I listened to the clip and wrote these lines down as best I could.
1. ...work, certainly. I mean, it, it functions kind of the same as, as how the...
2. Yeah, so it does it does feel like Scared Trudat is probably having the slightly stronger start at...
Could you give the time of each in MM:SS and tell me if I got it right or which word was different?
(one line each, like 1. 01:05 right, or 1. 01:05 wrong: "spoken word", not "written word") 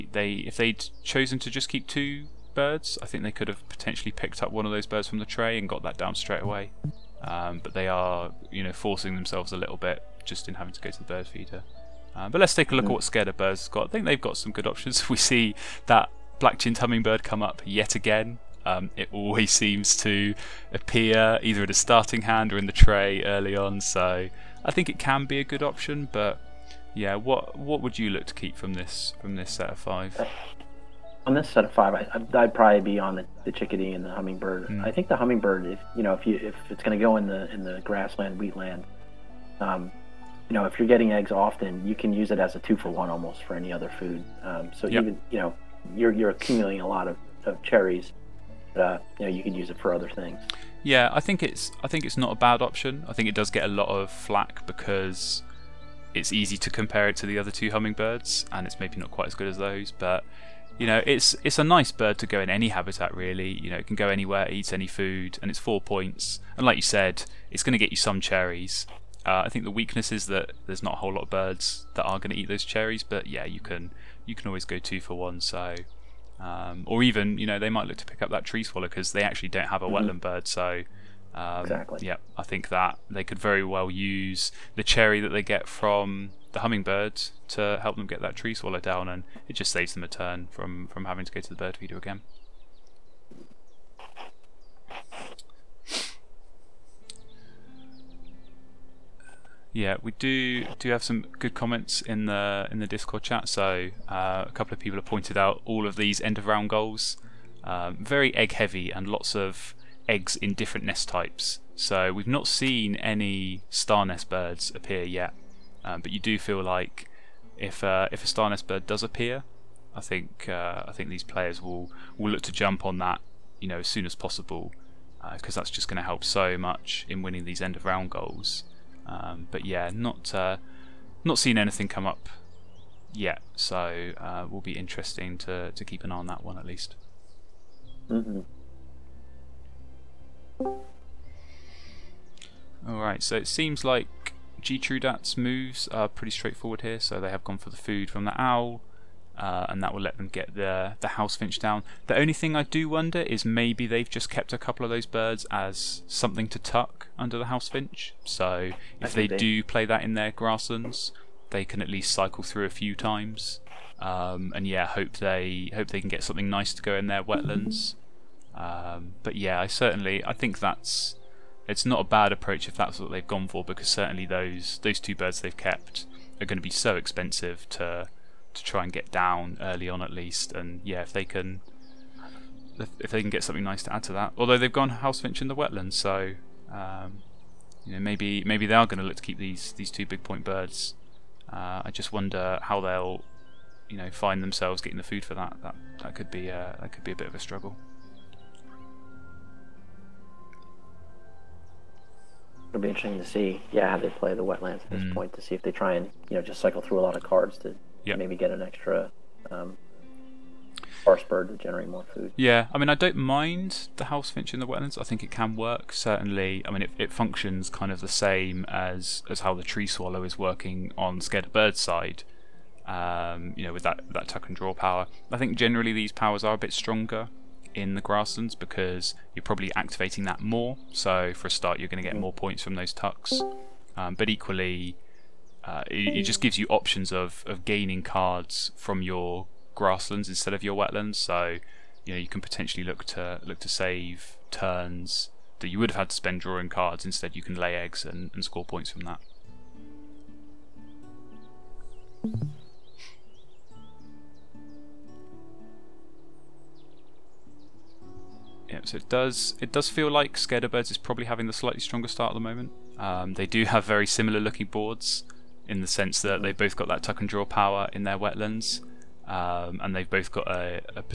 1. 03:35 right
2. 04:18 wrong: "Birds", not "Trudat".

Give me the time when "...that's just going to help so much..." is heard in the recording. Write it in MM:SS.
02:05.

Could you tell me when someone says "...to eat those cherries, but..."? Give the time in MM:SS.
01:12.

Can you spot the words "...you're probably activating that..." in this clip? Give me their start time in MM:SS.
03:49.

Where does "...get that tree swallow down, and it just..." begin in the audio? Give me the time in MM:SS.
01:28.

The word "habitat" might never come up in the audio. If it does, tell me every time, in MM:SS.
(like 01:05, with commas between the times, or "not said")
01:02.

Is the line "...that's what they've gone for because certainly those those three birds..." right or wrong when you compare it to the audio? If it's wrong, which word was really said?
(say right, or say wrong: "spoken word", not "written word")
wrong: "two", not "three".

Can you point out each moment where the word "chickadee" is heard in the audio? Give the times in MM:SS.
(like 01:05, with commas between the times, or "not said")
00:33.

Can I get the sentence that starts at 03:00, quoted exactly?
And yeah, if they can, if they can get something nice to add to that.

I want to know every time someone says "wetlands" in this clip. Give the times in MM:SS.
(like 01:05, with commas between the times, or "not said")
01:20, 02:47, 03:05, 03:24, 03:34, 04:00, 04:28.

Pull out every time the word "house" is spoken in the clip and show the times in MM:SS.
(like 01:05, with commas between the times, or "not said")
02:31, 02:37, 03:04, 03:34.